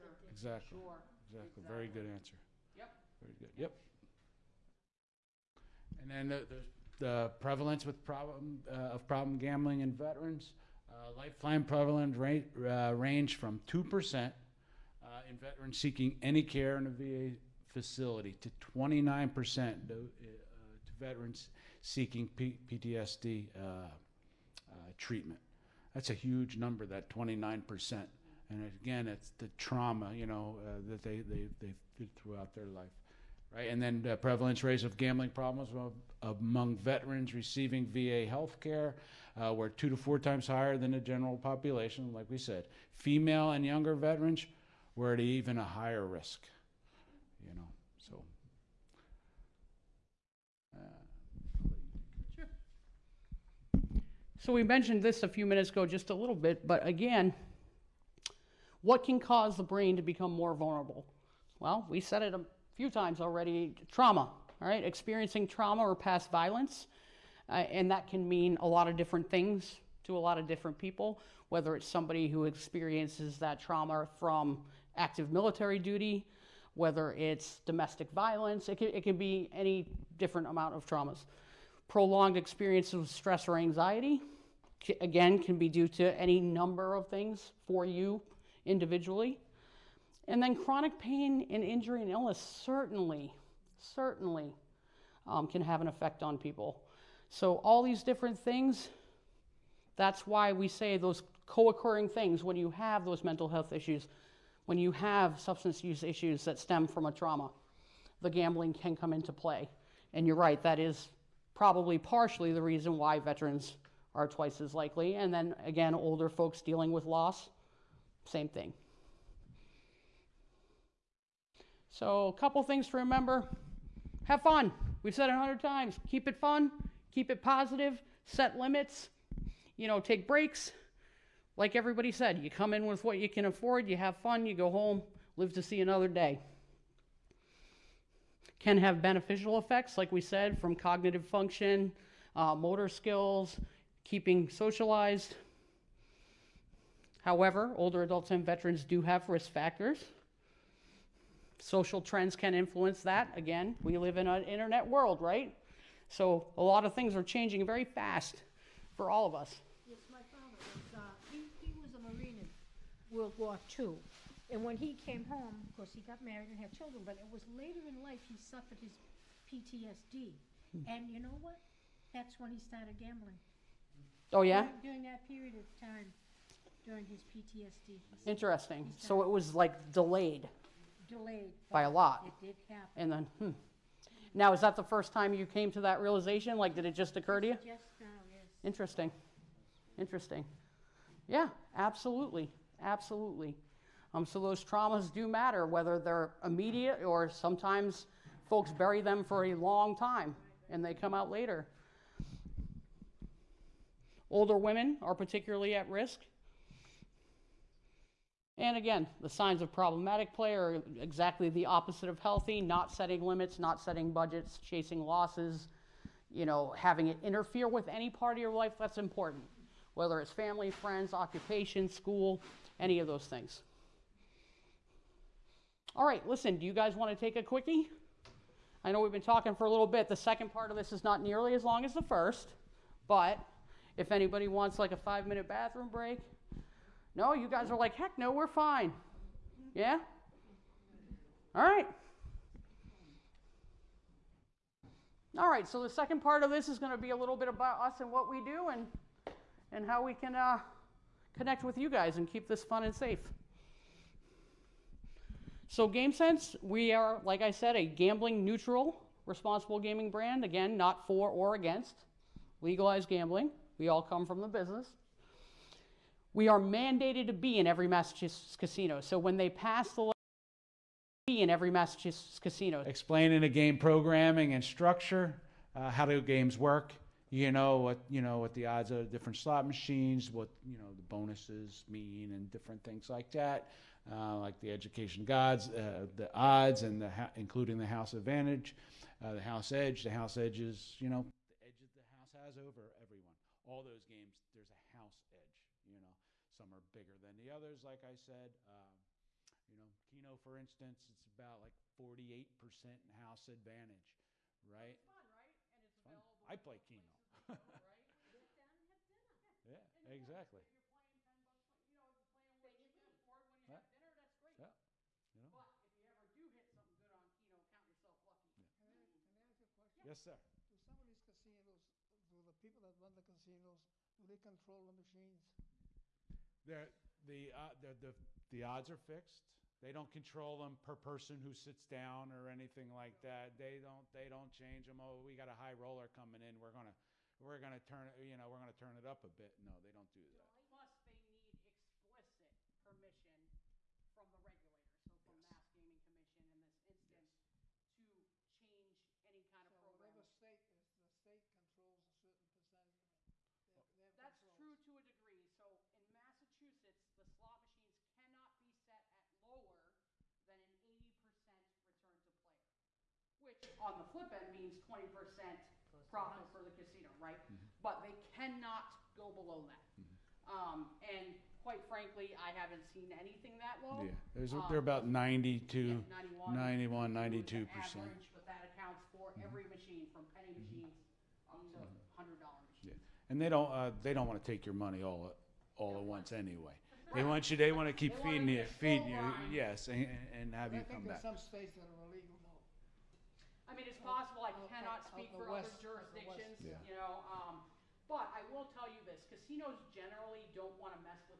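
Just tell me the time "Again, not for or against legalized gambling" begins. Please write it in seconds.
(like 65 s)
260 s.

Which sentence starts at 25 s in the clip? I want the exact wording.
That's a huge number, that 29%.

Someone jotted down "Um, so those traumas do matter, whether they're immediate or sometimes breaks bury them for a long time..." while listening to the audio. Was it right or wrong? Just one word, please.
wrong.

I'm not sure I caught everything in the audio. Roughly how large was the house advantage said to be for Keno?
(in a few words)
48%.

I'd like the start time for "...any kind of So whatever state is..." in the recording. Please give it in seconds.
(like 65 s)
349 s.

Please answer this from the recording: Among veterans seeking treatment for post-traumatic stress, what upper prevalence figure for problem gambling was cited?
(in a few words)
29%.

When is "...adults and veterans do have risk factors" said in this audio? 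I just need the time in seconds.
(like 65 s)
148 s.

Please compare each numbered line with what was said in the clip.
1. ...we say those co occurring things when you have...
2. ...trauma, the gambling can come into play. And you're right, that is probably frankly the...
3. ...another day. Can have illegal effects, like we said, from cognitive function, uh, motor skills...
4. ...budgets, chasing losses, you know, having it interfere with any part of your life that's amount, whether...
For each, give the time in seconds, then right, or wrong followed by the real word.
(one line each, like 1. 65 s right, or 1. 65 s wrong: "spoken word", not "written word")
1. 100 s right
2. 107 s wrong: "partially", not "frankly"
3. 135 s wrong: "beneficial", not "illegal"
4. 214 s wrong: "important", not "amount".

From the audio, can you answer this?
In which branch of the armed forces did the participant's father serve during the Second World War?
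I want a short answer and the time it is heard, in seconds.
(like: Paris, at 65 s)
Marine, at 162 s.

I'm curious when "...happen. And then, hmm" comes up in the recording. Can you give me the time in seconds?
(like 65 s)
182 s.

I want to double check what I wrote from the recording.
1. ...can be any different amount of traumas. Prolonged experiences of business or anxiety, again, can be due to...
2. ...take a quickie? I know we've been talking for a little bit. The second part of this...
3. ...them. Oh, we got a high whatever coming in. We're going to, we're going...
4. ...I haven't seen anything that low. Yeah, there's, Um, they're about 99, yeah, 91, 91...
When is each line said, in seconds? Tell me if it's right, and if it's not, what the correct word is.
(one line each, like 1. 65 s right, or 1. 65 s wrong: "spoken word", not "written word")
1. 79 s wrong: "stress", not "business"
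2. 227 s right
3. 334 s wrong: "roller", not "whatever"
4. 372 s wrong: "92", not "99".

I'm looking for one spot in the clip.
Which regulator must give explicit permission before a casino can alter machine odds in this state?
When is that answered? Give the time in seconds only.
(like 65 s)
345 s.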